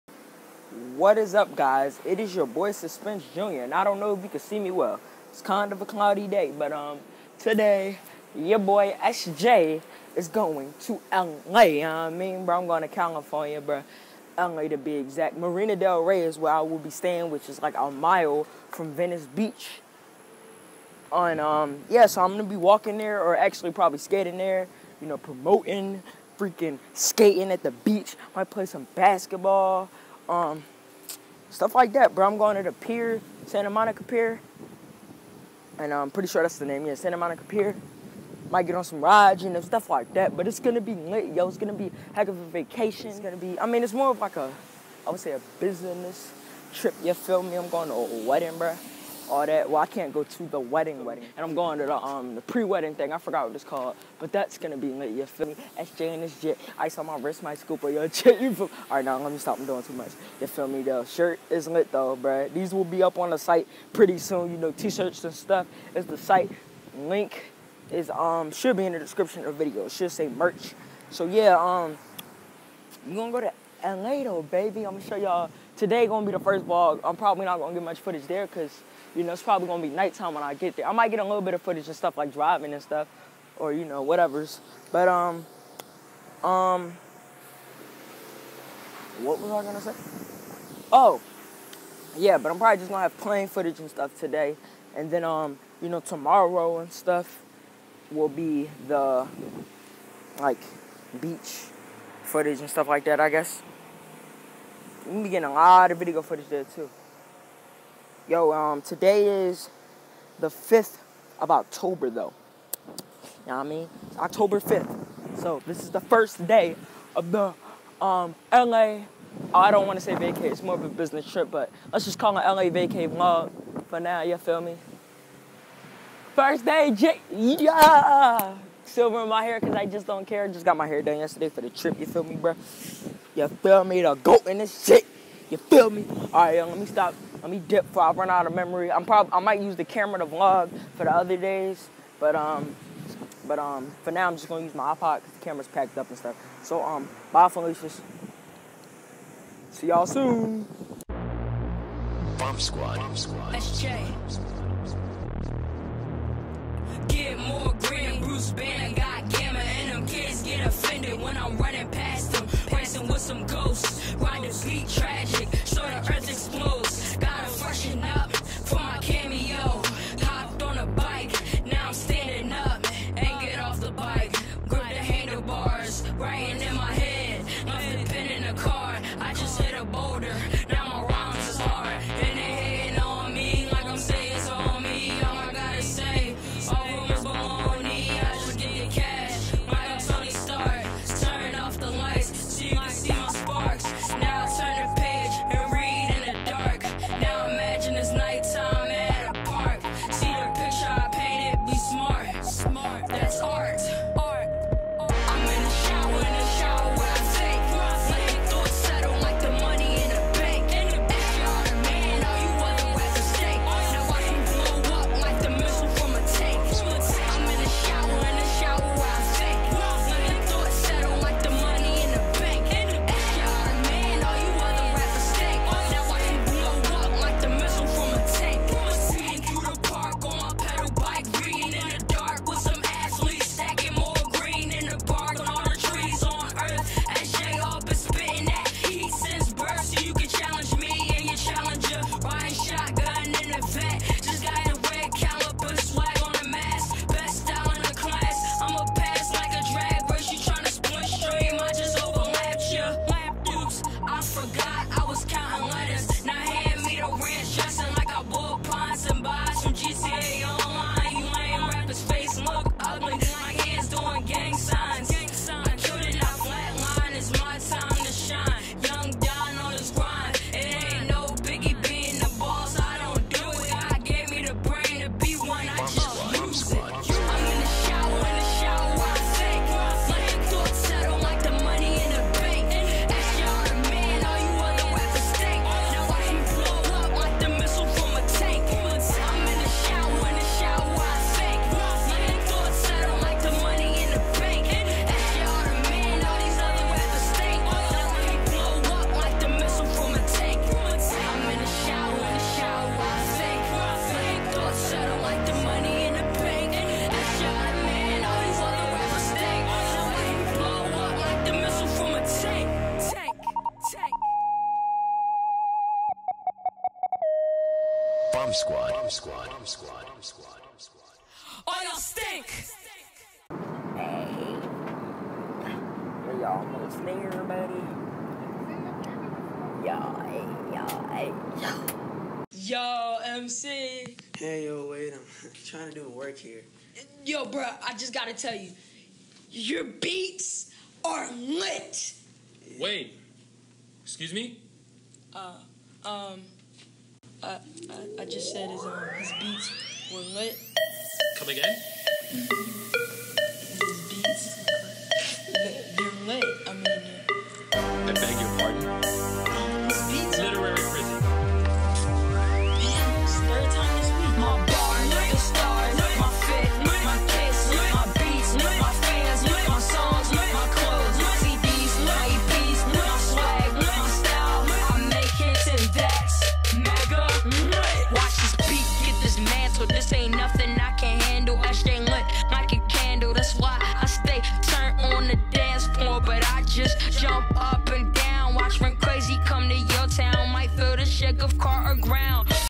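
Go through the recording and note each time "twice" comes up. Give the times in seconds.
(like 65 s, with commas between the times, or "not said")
not said.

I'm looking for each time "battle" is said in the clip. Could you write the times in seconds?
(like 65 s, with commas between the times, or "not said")
not said.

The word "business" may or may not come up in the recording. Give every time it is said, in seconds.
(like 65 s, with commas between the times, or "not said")
45 s, 120 s.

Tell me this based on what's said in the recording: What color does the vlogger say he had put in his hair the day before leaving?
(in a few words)
Silver.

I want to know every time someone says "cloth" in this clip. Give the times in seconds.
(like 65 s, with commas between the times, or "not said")
not said.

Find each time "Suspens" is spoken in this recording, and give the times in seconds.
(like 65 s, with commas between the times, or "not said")
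2 s.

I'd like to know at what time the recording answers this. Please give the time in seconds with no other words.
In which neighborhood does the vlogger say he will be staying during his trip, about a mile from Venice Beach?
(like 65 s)
15 s.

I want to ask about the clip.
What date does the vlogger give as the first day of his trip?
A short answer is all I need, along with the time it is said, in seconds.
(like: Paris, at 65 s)
October 5th, at 114 s.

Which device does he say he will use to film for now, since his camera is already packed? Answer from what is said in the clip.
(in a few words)
iPod.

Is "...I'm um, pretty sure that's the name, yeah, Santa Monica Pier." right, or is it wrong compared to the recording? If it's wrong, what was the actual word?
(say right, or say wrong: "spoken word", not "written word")
right.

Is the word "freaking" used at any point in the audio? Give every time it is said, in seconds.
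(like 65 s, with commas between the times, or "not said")
26 s.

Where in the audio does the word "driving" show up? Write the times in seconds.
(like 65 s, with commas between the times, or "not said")
82 s.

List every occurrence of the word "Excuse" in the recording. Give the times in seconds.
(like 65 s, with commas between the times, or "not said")
344 s.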